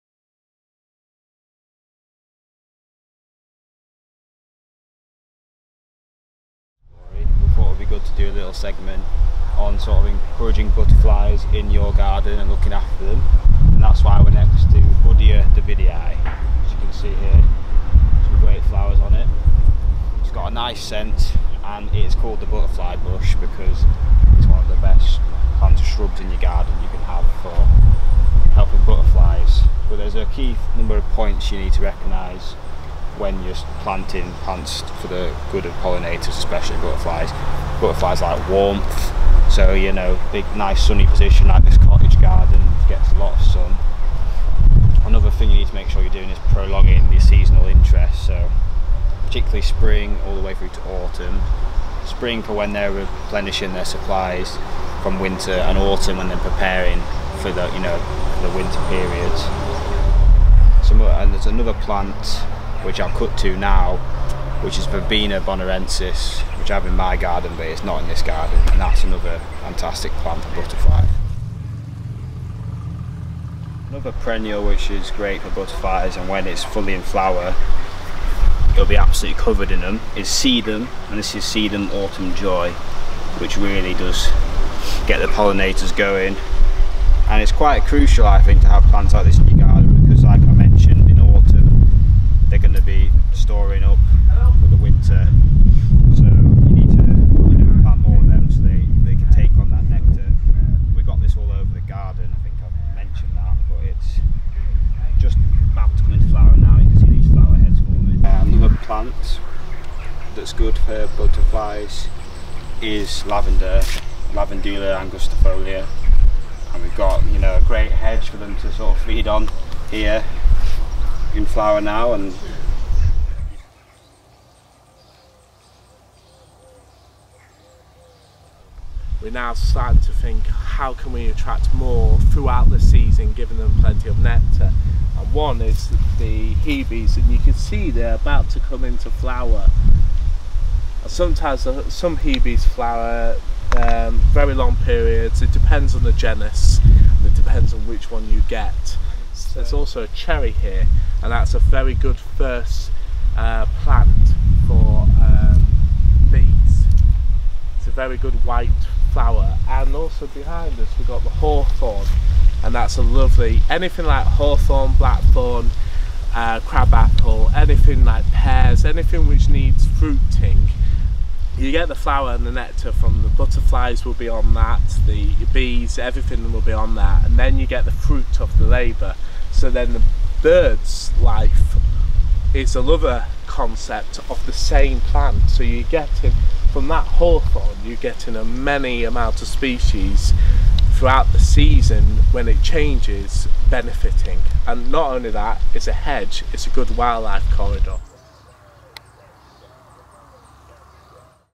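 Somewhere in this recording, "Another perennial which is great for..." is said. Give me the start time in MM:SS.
01:13.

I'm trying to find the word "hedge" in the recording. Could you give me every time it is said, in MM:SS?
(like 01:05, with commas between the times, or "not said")
01:57, 03:15.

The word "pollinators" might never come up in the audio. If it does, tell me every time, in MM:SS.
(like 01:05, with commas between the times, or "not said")
00:35, 01:25.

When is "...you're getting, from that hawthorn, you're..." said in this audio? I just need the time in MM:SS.
03:05.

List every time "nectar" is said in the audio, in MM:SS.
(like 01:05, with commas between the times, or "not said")
01:39, 02:14, 02:52.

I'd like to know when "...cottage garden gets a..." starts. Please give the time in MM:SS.
00:41.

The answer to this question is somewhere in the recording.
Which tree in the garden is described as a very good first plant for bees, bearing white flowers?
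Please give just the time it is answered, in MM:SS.
02:30.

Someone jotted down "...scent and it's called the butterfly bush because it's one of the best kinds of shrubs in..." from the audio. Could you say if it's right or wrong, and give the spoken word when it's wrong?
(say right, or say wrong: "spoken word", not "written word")
right.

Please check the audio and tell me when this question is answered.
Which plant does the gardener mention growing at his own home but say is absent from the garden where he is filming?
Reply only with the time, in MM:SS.
01:04.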